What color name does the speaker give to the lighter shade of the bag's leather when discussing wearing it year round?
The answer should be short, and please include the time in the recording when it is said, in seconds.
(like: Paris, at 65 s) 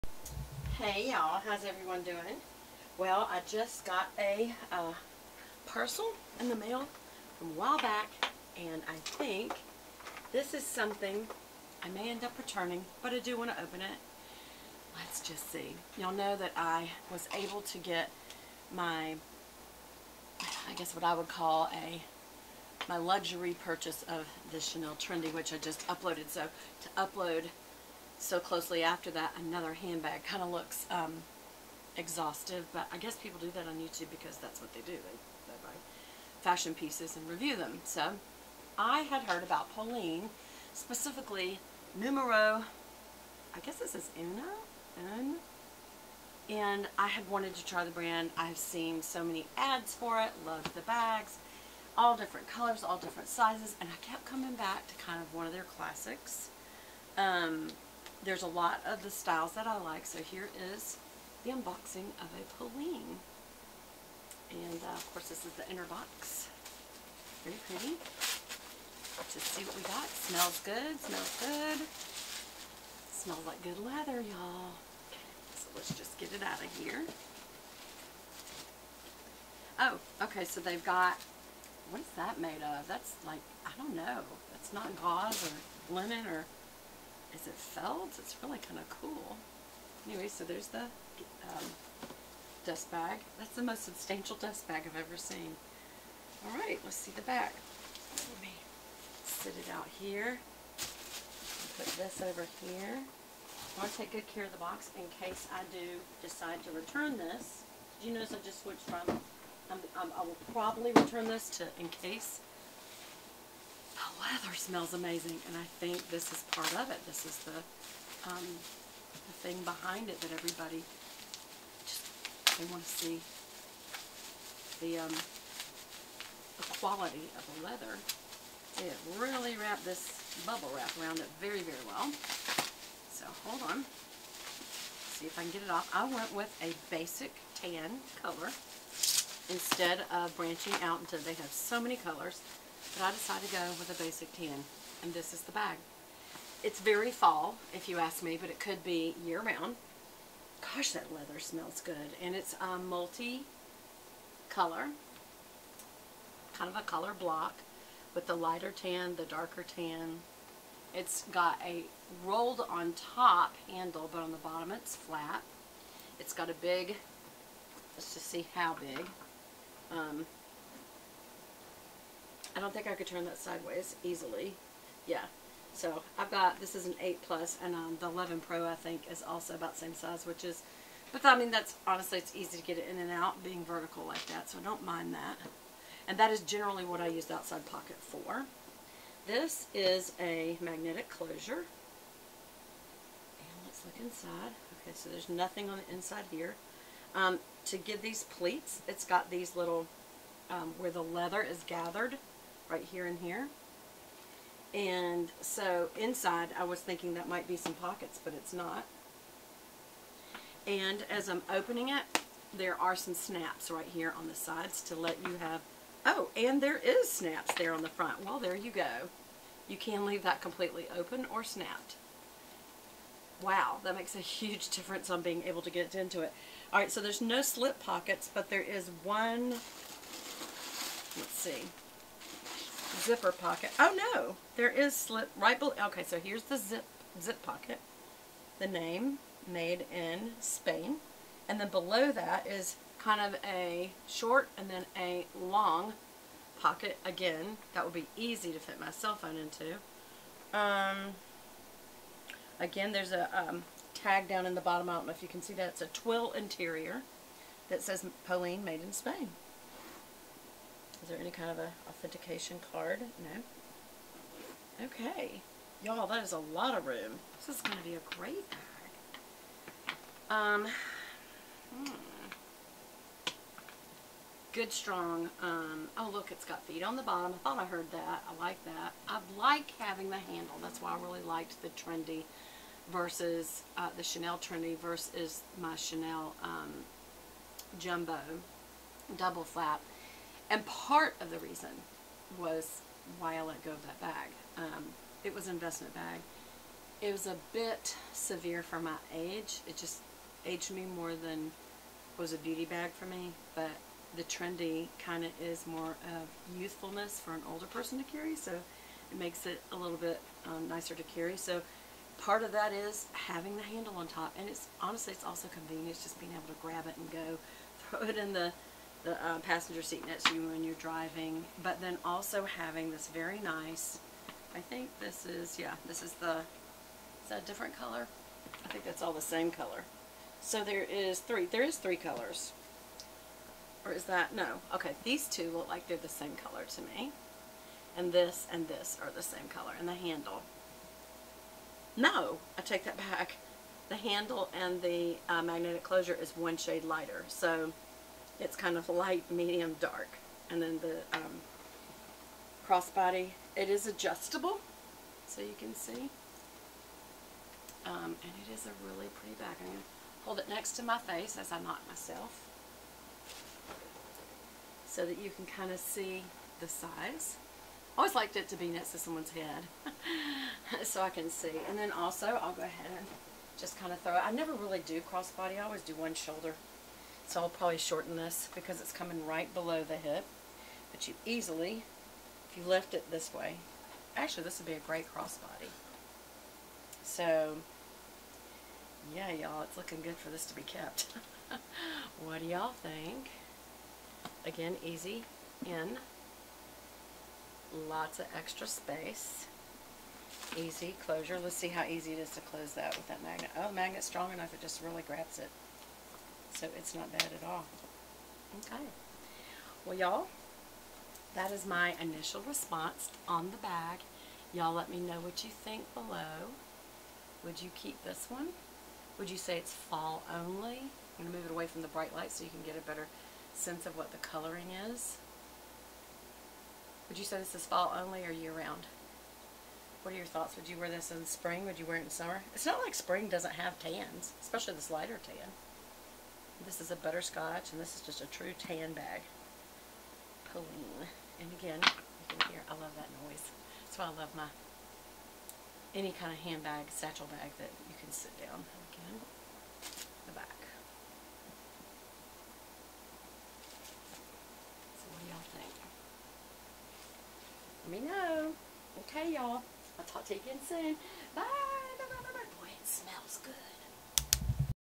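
Butterscotch, at 436 s.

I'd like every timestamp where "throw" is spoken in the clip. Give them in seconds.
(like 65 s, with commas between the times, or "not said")
317 s, 374 s.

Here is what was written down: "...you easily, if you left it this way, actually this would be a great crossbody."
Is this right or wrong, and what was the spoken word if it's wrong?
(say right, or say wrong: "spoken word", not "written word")
right.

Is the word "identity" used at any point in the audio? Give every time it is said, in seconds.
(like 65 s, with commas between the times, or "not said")
not said.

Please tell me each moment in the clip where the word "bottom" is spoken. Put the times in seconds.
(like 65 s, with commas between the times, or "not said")
164 s, 254 s, 277 s.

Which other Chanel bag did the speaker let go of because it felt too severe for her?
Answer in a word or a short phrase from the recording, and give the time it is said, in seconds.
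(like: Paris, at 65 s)
Jumbo double flap, at 287 s.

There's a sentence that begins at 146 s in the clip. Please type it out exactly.
It's very fall, if you ask me, but it could be year-round.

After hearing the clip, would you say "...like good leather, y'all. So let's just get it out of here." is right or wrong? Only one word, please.
right.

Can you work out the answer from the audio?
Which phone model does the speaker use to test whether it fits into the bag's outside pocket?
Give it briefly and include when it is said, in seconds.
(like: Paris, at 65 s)
8 Plus, at 176 s.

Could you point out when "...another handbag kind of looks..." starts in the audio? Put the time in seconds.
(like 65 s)
29 s.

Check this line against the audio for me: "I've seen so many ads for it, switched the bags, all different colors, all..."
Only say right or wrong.
wrong.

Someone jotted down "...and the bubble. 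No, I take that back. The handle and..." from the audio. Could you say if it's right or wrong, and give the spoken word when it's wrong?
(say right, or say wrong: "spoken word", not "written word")
wrong: "handle", not "bubble".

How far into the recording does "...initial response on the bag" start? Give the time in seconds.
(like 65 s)
412 s.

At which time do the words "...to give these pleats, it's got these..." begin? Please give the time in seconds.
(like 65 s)
197 s.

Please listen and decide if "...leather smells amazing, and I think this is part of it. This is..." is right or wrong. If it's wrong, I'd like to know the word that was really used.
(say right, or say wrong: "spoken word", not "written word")
right.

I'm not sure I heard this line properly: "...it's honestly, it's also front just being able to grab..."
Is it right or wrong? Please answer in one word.
wrong.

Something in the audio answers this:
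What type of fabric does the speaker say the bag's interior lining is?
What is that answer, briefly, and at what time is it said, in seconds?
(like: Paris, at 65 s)
Twill, at 255 s.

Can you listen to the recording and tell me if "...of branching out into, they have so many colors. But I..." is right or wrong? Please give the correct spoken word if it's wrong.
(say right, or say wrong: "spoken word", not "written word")
right.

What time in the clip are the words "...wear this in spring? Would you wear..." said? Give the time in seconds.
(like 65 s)
430 s.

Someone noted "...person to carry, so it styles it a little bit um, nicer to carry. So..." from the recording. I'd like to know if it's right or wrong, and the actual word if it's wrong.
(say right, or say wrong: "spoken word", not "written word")
wrong: "makes", not "styles".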